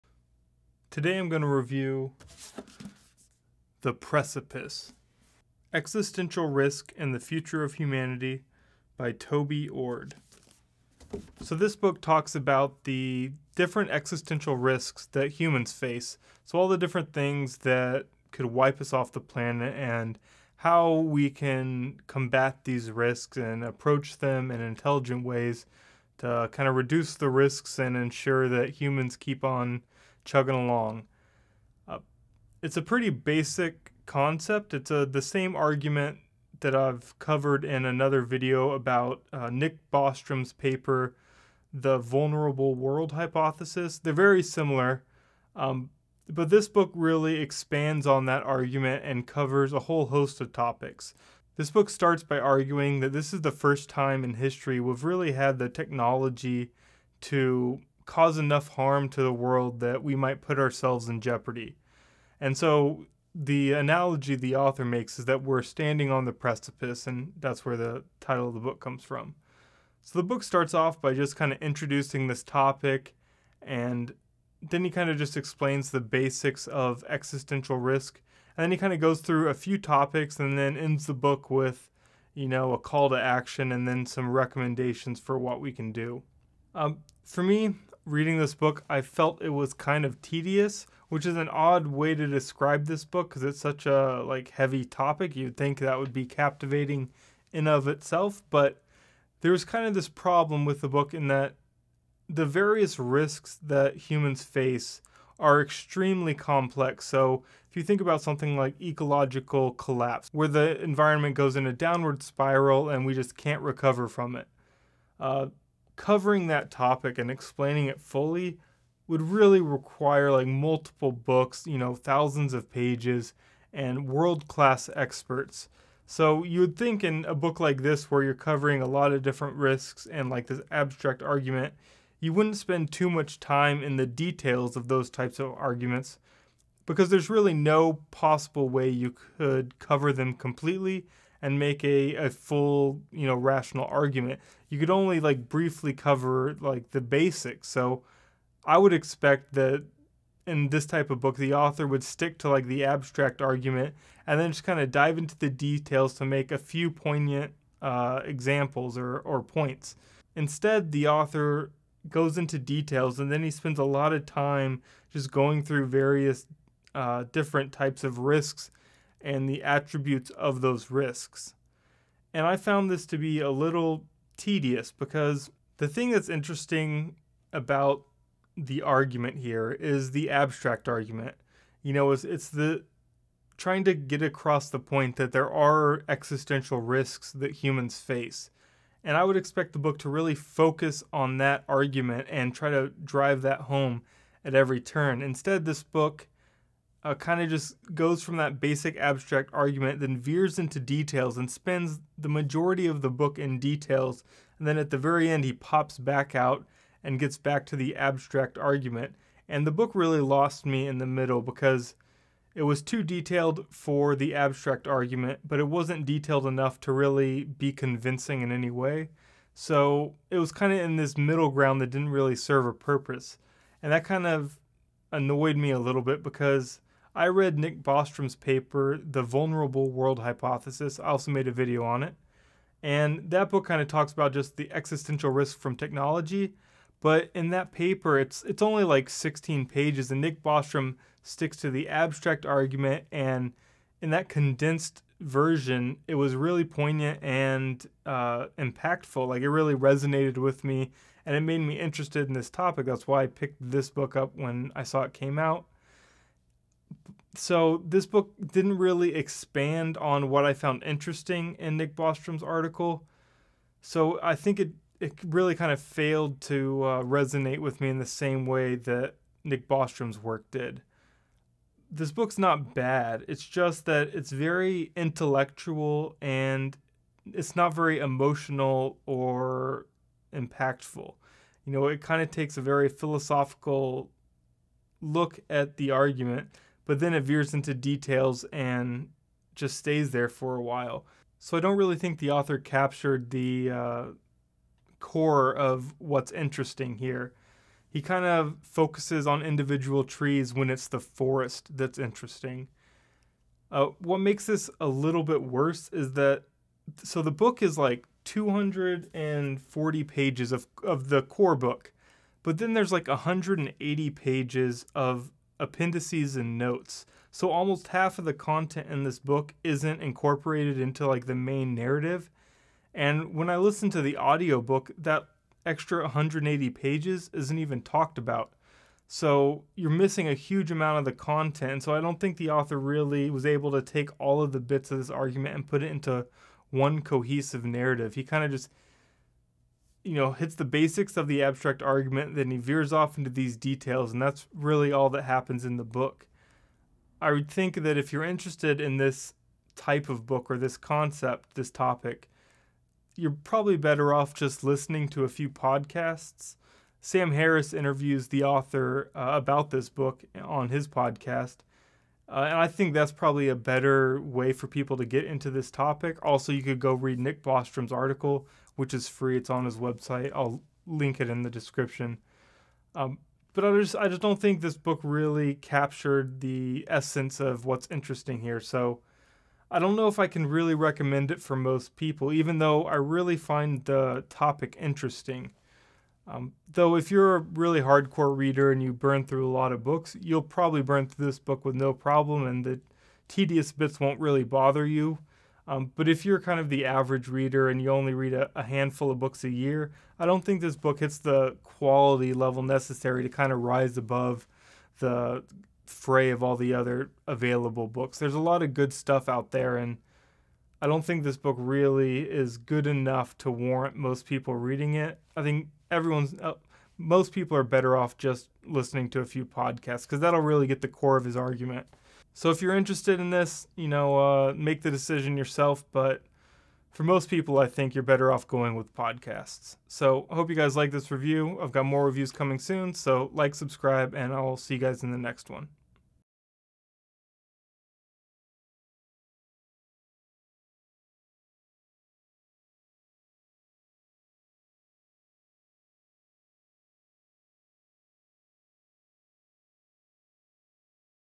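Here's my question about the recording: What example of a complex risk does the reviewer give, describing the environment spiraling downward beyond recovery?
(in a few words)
Ecological collapse.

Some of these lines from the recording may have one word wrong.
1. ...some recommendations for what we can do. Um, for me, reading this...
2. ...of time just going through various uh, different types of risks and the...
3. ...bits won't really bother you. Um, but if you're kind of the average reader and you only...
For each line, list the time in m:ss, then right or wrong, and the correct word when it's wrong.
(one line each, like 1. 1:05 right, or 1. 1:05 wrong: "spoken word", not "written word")
1. 1:24 right
2. 2:44 right
3. 6:33 right.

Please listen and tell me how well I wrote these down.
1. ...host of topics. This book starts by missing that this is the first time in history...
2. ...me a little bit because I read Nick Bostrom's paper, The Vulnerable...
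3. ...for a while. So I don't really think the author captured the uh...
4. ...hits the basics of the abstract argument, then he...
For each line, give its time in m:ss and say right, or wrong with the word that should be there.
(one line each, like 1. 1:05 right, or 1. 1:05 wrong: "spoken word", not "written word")
1. 0:50 wrong: "arguing", not "missing"
2. 3:45 right
3. 4:50 right
4. 5:40 right.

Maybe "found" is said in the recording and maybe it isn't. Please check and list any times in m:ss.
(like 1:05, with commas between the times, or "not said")
2:52, 4:20.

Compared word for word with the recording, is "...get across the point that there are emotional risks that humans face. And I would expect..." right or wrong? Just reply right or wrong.
wrong.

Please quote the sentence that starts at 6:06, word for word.
Also, you could go read Nick Bostrom's article, which is free.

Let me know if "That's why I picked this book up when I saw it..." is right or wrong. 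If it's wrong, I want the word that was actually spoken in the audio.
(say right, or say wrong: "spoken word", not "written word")
right.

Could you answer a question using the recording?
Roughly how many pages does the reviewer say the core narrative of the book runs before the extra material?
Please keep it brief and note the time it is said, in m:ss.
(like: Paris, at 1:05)
240, at 5:08.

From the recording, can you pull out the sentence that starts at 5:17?
So almost half of the content in this book isn't incorporated into like the main narrative.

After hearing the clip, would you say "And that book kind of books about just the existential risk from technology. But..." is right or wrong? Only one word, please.
wrong.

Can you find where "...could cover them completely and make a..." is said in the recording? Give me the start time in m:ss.
2:19.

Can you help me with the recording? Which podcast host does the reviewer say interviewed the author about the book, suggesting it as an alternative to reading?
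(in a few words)
Sam Harris.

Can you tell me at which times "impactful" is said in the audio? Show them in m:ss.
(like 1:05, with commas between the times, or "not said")
4:08, 4:40.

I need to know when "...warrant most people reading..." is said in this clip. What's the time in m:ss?
6:53.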